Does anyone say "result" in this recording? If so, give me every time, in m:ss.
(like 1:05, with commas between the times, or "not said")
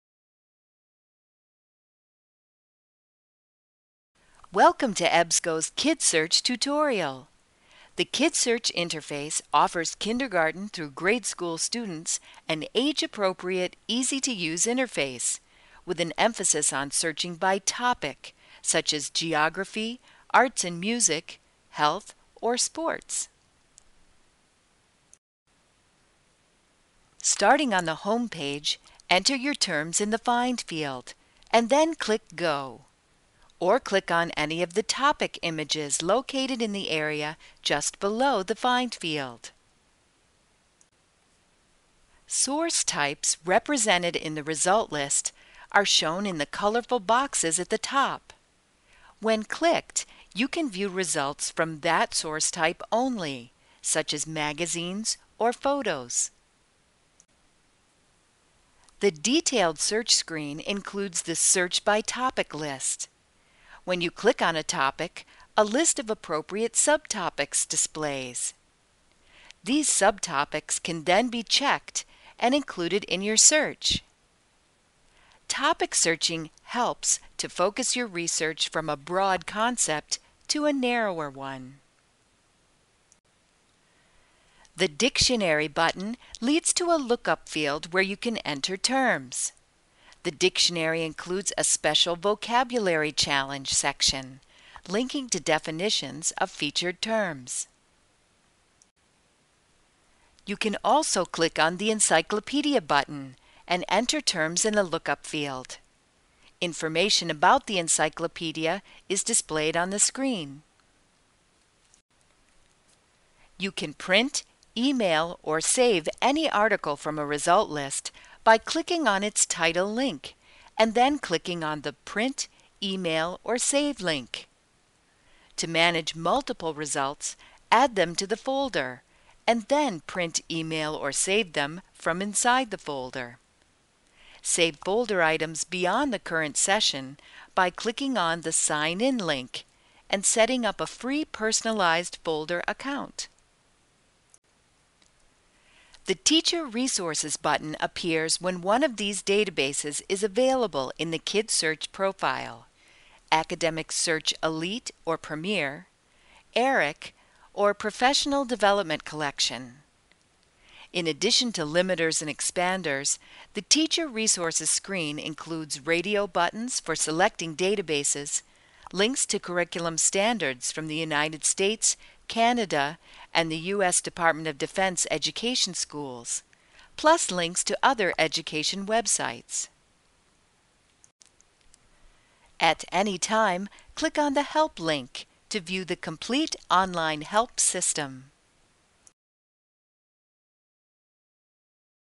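0:44, 0:50, 1:57, 2:06.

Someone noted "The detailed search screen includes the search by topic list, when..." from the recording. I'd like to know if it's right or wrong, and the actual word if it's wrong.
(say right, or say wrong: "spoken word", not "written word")
right.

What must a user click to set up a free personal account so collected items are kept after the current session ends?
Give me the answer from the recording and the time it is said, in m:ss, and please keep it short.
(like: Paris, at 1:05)
Sign In link, at 2:18.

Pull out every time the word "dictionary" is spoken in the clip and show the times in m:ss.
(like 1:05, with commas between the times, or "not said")
1:24, 1:30.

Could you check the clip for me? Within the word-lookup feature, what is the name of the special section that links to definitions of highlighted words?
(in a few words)
vocabulary challenge.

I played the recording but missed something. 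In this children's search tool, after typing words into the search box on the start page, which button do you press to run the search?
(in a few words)
Go.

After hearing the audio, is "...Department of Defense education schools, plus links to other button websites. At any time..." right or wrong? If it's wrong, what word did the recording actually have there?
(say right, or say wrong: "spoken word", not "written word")
wrong: "education", not "button".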